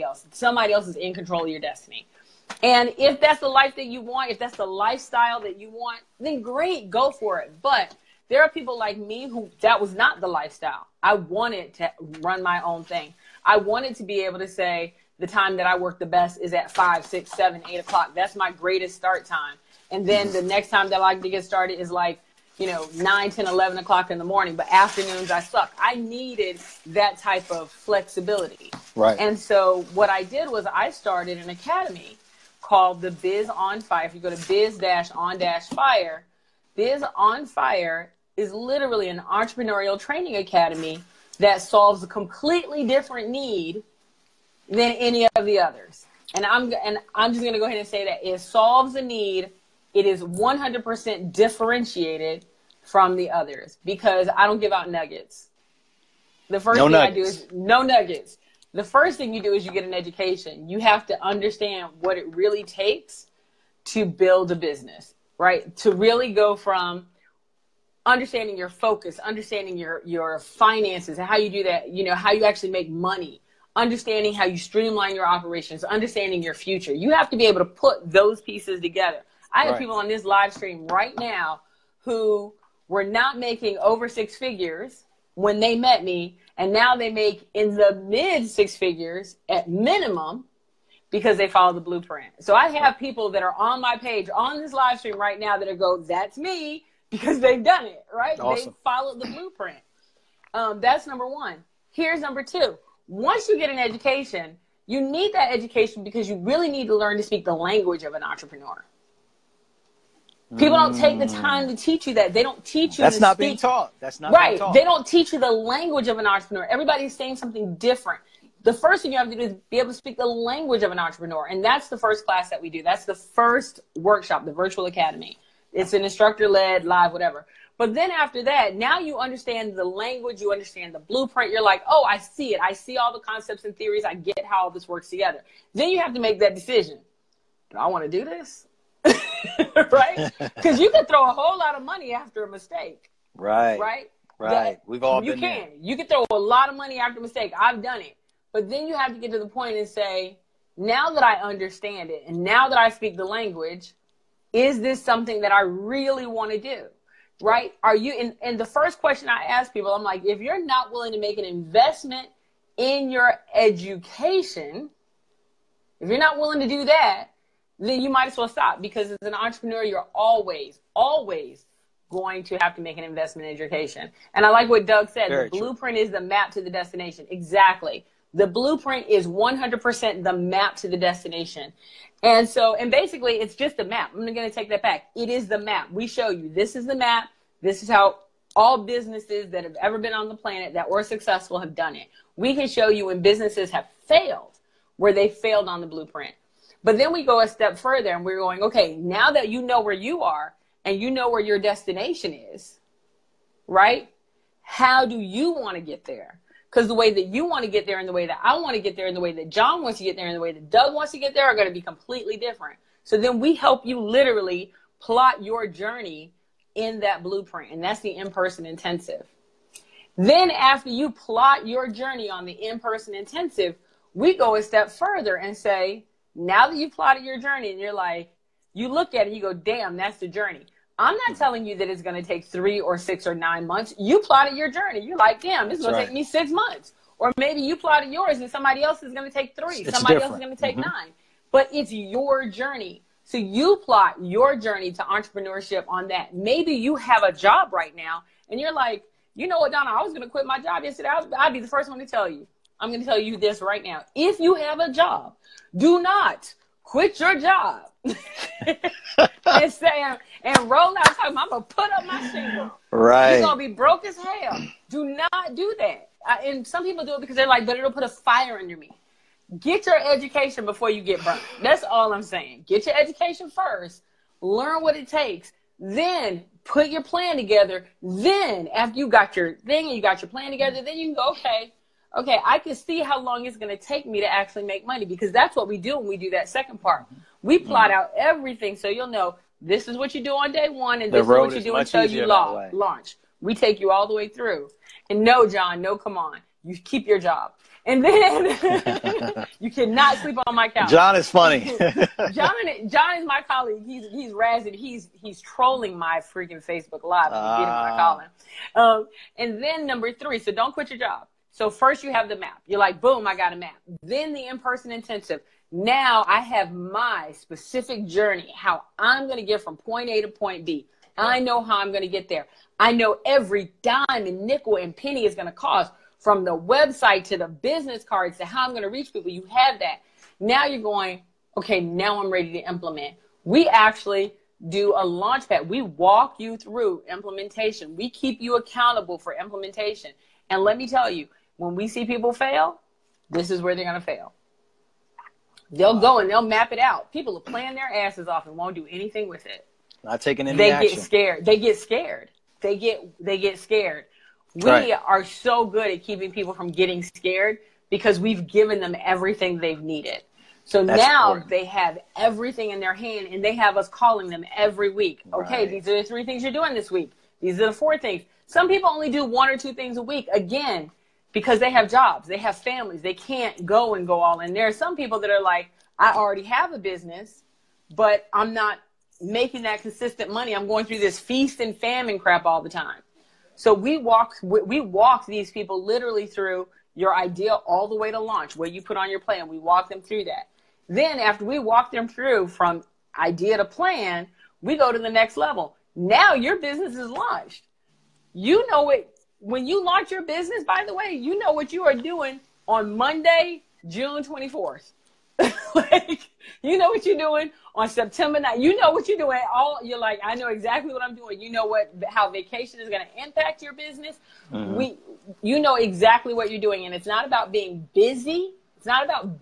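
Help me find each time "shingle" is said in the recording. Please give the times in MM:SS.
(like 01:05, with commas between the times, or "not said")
04:22.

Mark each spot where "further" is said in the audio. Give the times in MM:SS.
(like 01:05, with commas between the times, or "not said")
03:17, 03:44.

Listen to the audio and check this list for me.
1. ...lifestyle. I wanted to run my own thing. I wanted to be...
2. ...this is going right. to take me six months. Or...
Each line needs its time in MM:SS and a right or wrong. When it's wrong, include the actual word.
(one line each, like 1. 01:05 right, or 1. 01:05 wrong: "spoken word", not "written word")
1. 00:10 right
2. 03:55 right.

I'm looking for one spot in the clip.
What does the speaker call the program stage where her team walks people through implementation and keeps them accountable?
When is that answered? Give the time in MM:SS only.
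05:35.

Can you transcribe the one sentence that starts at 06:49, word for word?
All you're like, I know exactly what I'm doing.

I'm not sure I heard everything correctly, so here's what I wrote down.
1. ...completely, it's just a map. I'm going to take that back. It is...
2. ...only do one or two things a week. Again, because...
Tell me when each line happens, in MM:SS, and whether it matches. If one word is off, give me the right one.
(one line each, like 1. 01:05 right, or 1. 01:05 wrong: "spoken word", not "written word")
1. 03:02 wrong: "basically", not "completely"
2. 06:08 right.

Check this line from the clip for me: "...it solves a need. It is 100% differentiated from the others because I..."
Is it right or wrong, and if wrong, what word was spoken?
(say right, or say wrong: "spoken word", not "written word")
right.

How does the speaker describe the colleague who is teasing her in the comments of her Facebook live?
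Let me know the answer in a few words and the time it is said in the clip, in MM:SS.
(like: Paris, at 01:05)
my colleague, at 05:03.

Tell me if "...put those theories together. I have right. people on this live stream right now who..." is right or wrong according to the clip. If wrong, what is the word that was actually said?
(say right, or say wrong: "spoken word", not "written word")
wrong: "pieces", not "theories".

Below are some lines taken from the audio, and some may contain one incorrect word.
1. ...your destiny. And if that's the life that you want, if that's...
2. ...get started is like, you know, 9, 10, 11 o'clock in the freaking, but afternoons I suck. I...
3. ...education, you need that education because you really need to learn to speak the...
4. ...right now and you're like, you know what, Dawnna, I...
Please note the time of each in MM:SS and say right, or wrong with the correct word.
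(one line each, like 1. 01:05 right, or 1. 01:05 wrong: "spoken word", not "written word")
1. 00:01 right
2. 00:21 wrong: "morning", not "freaking"
3. 01:43 right
4. 04:07 right.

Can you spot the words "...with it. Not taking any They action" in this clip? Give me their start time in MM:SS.
05:49.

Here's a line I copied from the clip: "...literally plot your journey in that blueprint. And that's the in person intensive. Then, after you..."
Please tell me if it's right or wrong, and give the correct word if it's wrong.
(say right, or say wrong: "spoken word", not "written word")
right.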